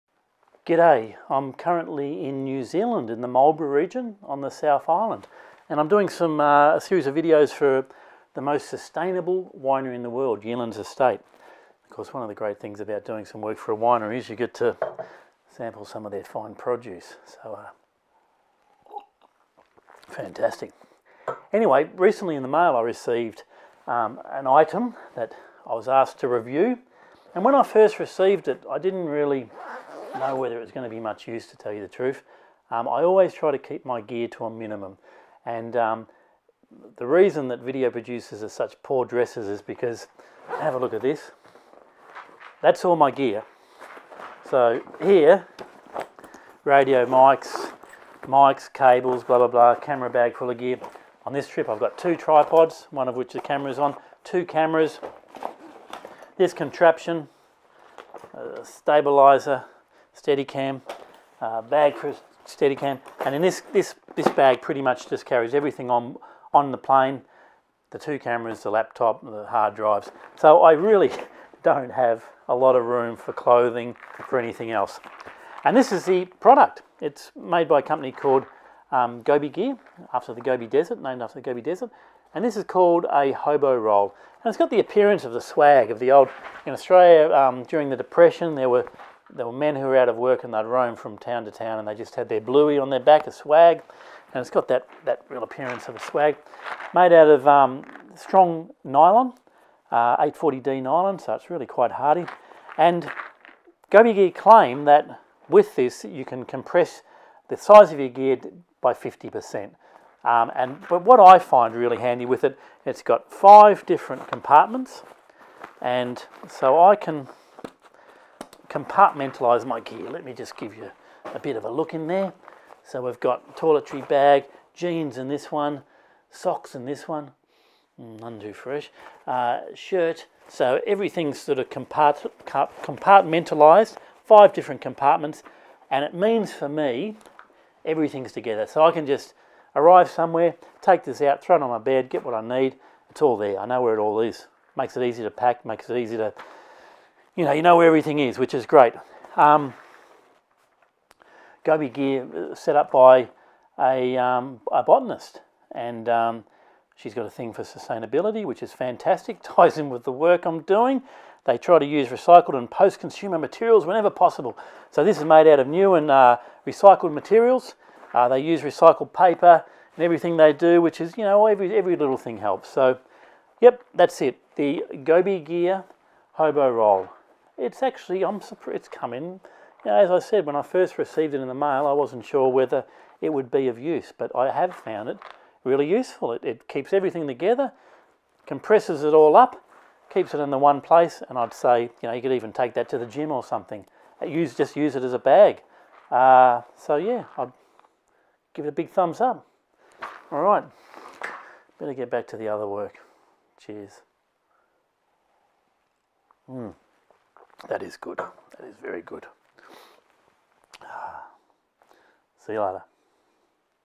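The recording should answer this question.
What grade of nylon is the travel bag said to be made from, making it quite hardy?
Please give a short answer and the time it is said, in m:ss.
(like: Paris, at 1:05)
840D, at 1:40.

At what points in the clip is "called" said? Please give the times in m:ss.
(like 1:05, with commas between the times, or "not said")
1:18, 1:22.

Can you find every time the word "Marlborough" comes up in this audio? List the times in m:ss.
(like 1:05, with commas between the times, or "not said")
0:03.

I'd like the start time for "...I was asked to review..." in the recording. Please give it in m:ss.
0:25.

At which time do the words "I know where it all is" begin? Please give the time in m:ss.
2:23.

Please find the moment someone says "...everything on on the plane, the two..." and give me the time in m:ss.
1:05.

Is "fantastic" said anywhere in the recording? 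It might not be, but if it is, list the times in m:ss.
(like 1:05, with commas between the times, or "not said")
0:20, 2:38.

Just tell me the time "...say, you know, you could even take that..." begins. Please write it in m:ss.
3:11.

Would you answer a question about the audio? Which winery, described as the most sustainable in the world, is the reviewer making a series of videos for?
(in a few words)
Yealands Estate.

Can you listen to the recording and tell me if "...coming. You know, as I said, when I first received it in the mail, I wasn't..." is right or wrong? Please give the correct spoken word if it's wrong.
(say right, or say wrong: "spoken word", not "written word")
right.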